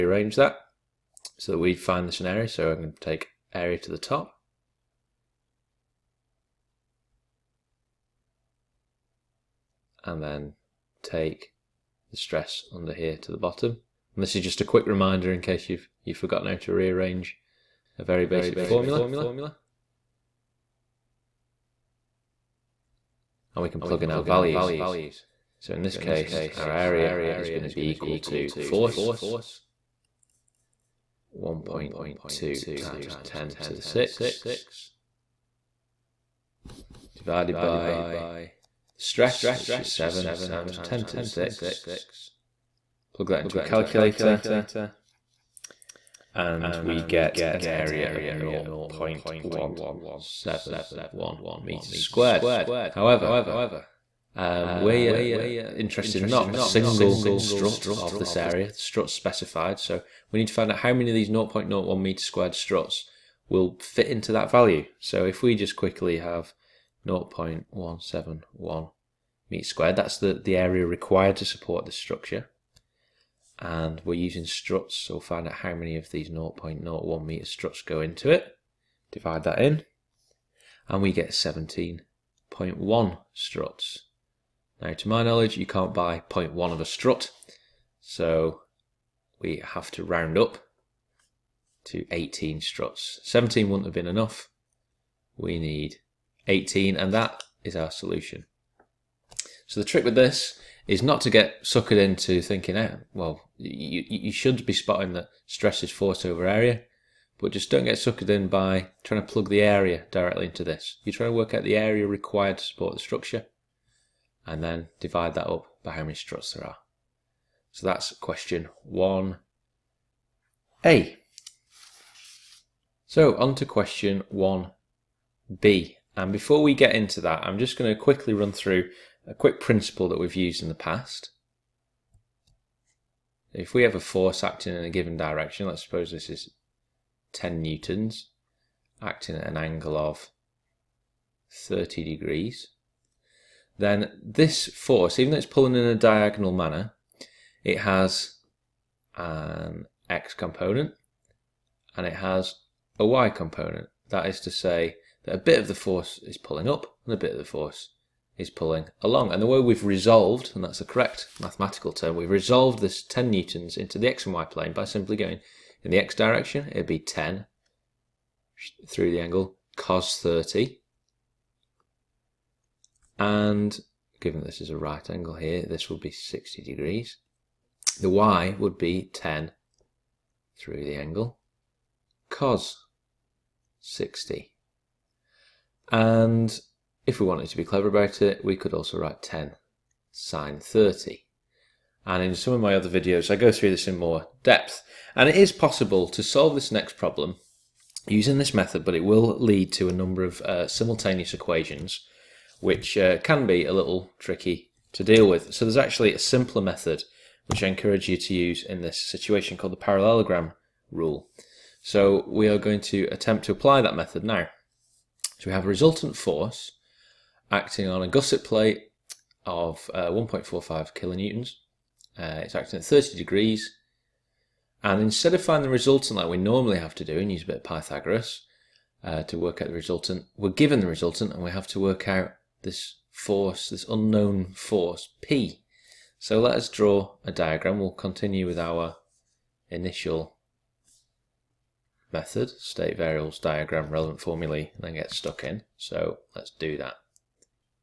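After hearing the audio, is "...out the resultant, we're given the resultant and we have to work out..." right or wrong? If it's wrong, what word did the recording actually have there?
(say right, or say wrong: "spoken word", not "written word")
right.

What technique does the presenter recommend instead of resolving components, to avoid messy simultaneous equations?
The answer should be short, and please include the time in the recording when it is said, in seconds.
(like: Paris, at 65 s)
parallelogram rule, at 209 s.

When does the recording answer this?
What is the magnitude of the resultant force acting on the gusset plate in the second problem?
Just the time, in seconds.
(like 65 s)
220 s.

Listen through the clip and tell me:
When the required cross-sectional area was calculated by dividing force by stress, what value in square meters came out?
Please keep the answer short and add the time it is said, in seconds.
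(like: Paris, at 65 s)
0.171 square meters, at 48 s.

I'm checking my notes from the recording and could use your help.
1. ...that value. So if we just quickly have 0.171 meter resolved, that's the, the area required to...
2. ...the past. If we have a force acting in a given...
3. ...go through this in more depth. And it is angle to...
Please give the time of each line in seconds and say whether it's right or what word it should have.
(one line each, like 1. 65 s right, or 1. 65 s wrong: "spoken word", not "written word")
1. 64 s wrong: "squared", not "resolved"
2. 130 s right
3. 193 s wrong: "possible", not "angle".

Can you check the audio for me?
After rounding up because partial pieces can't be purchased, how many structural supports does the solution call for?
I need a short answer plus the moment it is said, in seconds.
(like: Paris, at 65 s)
18, at 92 s.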